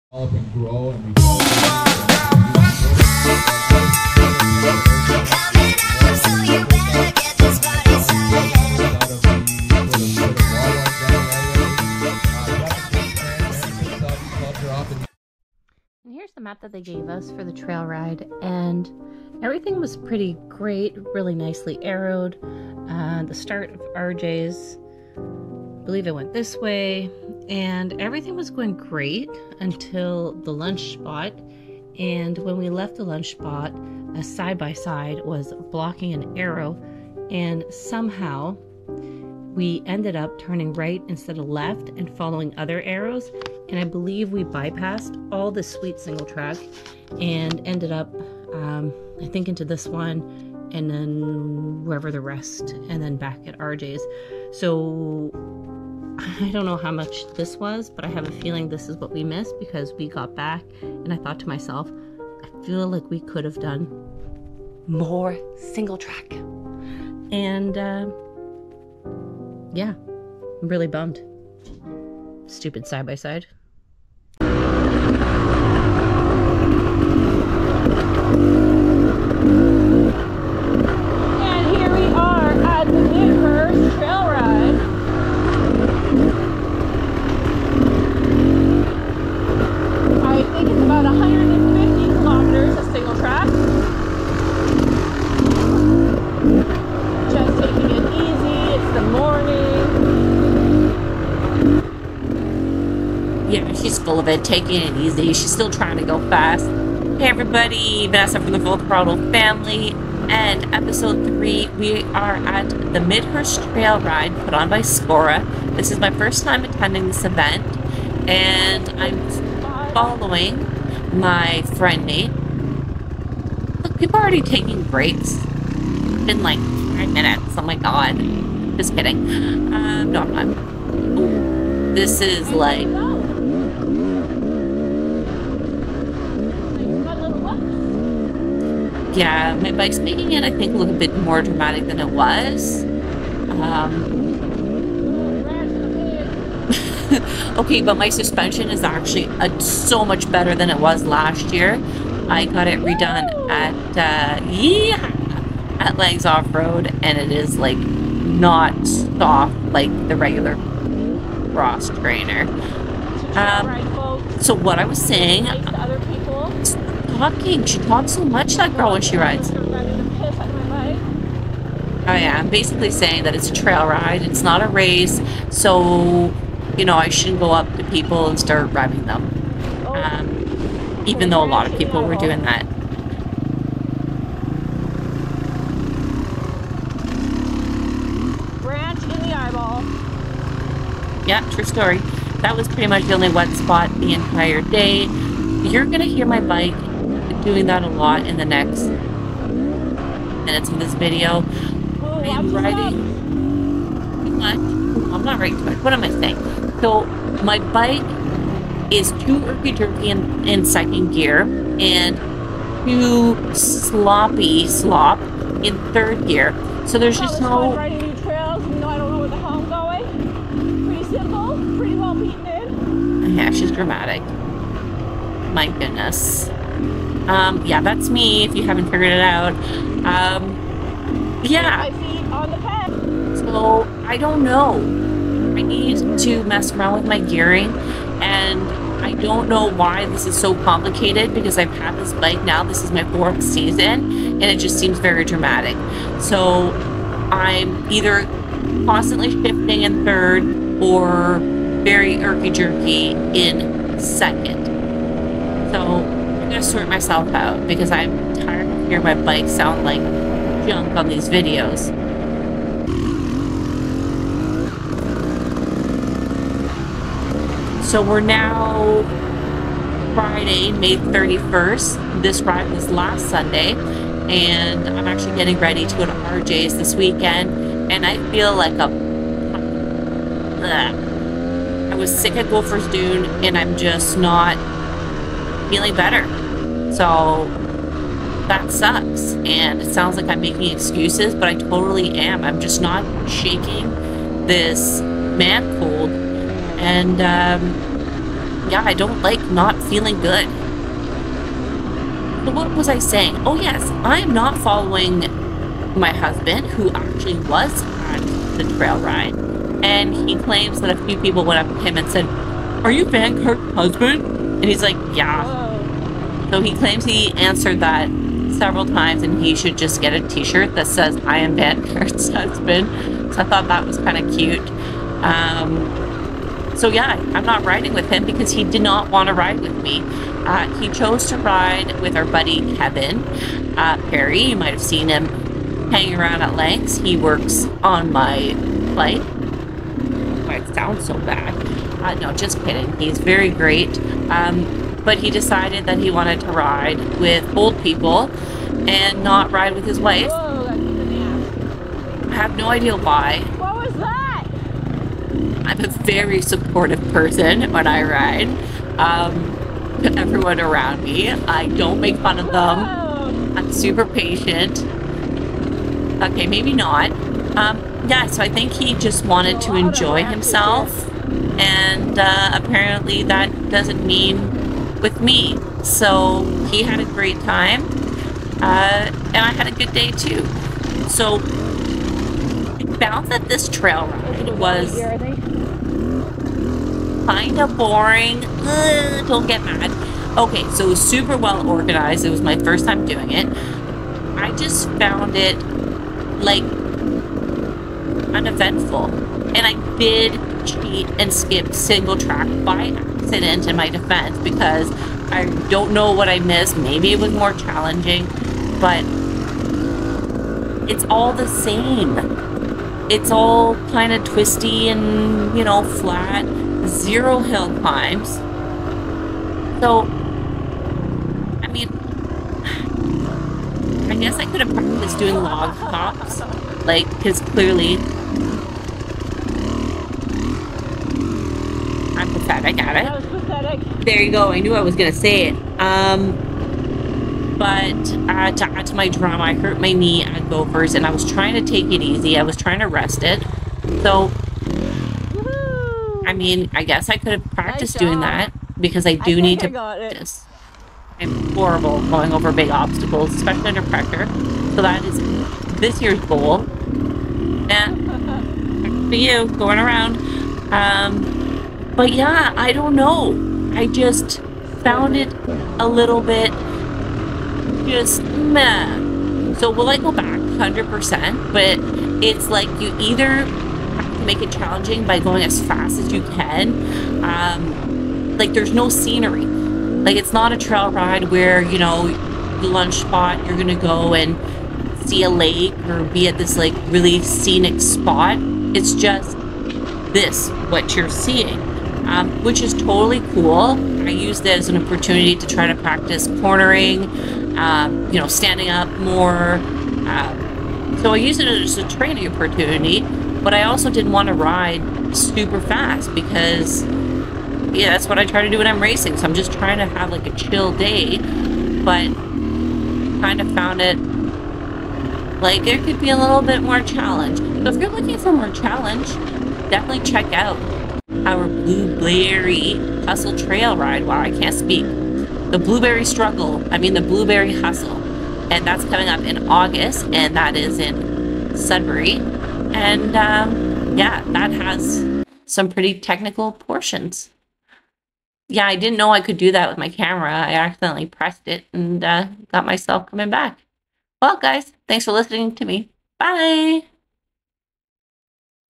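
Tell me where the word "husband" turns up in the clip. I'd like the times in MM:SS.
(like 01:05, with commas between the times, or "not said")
05:06, 05:13, 05:22.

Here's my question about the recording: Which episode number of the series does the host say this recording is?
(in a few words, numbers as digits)
3.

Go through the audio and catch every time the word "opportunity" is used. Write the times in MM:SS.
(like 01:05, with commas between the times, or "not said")
08:14, 08:22.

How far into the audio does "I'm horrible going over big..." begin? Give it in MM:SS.
07:31.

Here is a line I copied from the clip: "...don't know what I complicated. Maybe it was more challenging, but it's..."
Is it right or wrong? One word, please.
wrong.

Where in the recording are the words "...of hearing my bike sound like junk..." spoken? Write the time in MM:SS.
04:18.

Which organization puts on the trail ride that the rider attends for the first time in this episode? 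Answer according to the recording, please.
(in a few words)
SCORRA.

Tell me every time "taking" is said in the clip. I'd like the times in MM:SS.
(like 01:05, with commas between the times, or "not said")
01:44, 02:04.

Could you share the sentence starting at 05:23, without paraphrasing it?
So I thought that was kind of cute.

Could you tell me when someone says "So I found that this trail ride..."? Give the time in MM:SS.
06:21.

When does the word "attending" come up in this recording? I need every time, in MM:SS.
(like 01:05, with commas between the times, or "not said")
01:56.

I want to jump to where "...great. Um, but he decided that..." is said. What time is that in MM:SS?
05:43.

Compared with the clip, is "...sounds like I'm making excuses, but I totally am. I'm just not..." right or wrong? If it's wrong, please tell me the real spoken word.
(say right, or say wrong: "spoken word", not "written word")
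right.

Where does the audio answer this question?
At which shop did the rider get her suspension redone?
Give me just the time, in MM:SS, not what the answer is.
02:35.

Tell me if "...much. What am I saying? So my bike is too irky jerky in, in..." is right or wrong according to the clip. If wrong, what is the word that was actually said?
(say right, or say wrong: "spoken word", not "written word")
right.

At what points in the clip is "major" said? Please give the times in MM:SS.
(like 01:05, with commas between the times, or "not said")
not said.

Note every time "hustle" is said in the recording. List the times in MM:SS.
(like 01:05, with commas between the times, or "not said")
08:43, 08:47.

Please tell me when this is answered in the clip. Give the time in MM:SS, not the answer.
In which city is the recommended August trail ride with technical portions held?
08:51.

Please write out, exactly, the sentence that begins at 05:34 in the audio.
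You might have seen him hanging around at Lanks.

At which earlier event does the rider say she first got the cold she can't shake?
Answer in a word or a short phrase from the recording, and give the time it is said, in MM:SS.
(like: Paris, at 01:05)
Gopher's Dune, at 04:42.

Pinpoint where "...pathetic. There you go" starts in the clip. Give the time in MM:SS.
07:13.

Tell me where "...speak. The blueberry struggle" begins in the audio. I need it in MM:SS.
08:44.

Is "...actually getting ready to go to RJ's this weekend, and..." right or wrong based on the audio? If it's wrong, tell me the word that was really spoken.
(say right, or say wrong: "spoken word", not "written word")
right.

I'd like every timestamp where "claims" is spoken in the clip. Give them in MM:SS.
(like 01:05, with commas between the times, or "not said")
05:10, 05:16.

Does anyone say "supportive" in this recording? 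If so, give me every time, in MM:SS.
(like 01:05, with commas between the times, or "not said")
05:56.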